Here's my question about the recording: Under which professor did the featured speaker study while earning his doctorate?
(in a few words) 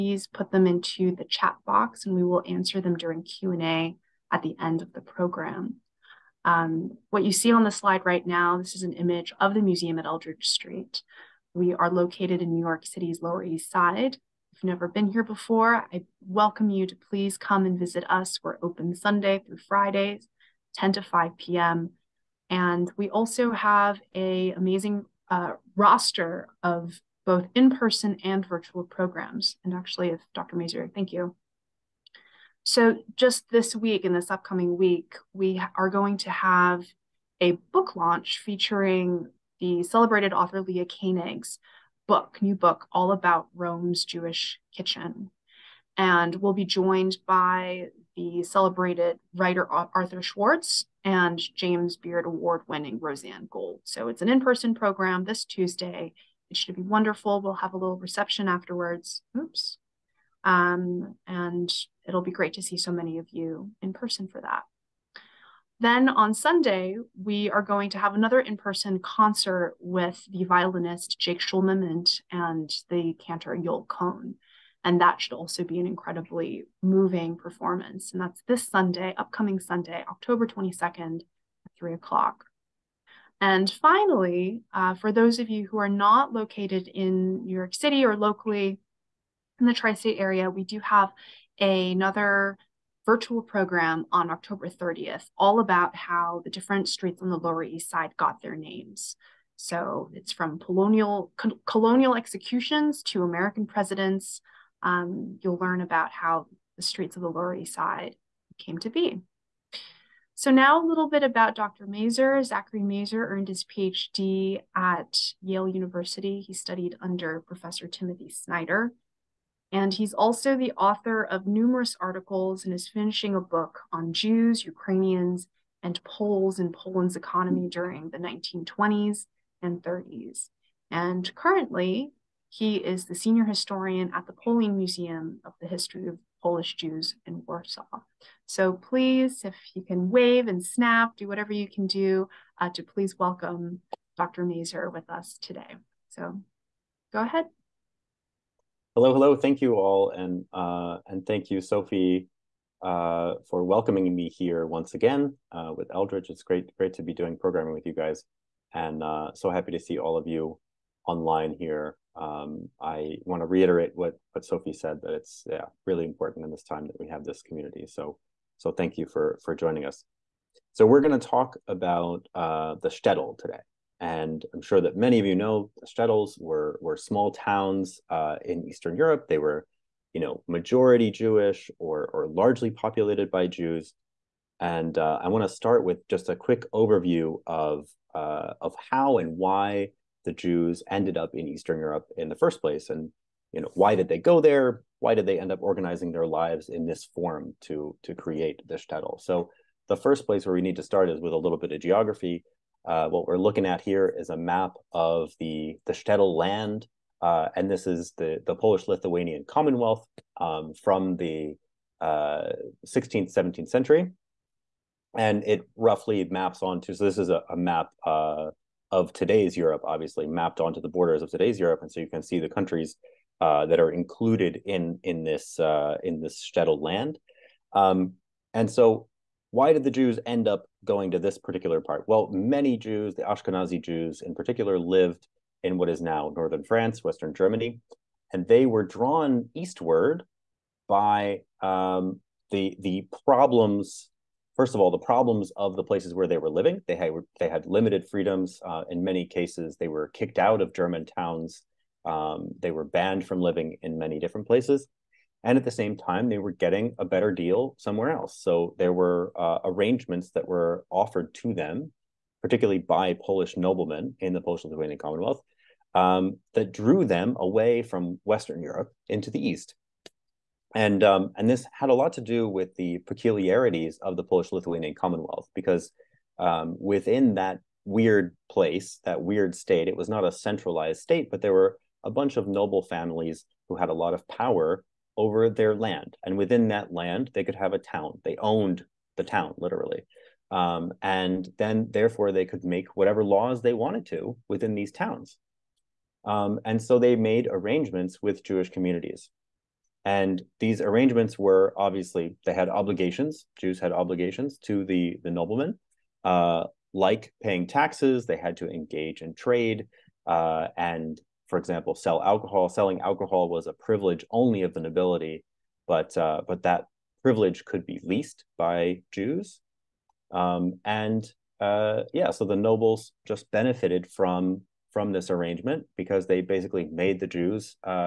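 Timothy Snyder.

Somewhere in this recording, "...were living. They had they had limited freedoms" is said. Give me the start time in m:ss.
4:06.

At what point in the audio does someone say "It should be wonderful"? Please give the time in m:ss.
0:56.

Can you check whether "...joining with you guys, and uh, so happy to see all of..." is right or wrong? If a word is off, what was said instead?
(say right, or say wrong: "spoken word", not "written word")
wrong: "programming", not "joining".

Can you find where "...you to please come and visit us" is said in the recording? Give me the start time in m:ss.
0:16.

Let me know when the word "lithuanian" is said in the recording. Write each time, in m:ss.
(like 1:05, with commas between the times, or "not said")
3:28, 4:24, 4:34.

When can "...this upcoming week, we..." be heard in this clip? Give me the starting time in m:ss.
0:34.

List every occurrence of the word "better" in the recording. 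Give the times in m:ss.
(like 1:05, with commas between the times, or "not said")
4:17.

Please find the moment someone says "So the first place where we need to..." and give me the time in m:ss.
3:19.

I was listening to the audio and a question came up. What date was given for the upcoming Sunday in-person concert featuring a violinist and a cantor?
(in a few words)
October 22.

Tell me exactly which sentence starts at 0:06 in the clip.
Um, what you see on the slide right now, this is an image of the museum at Eldridge Street.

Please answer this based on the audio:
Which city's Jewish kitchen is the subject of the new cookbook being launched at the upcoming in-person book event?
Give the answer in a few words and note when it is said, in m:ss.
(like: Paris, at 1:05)
Rome, at 0:43.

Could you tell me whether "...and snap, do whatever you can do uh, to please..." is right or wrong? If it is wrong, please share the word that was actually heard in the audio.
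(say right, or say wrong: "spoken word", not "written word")
right.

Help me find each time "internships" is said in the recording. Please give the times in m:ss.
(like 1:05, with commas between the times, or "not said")
not said.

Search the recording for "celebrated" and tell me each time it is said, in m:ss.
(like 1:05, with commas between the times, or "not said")
0:39, 0:48.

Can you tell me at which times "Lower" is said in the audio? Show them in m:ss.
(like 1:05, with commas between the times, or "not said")
0:13, 1:37, 1:47.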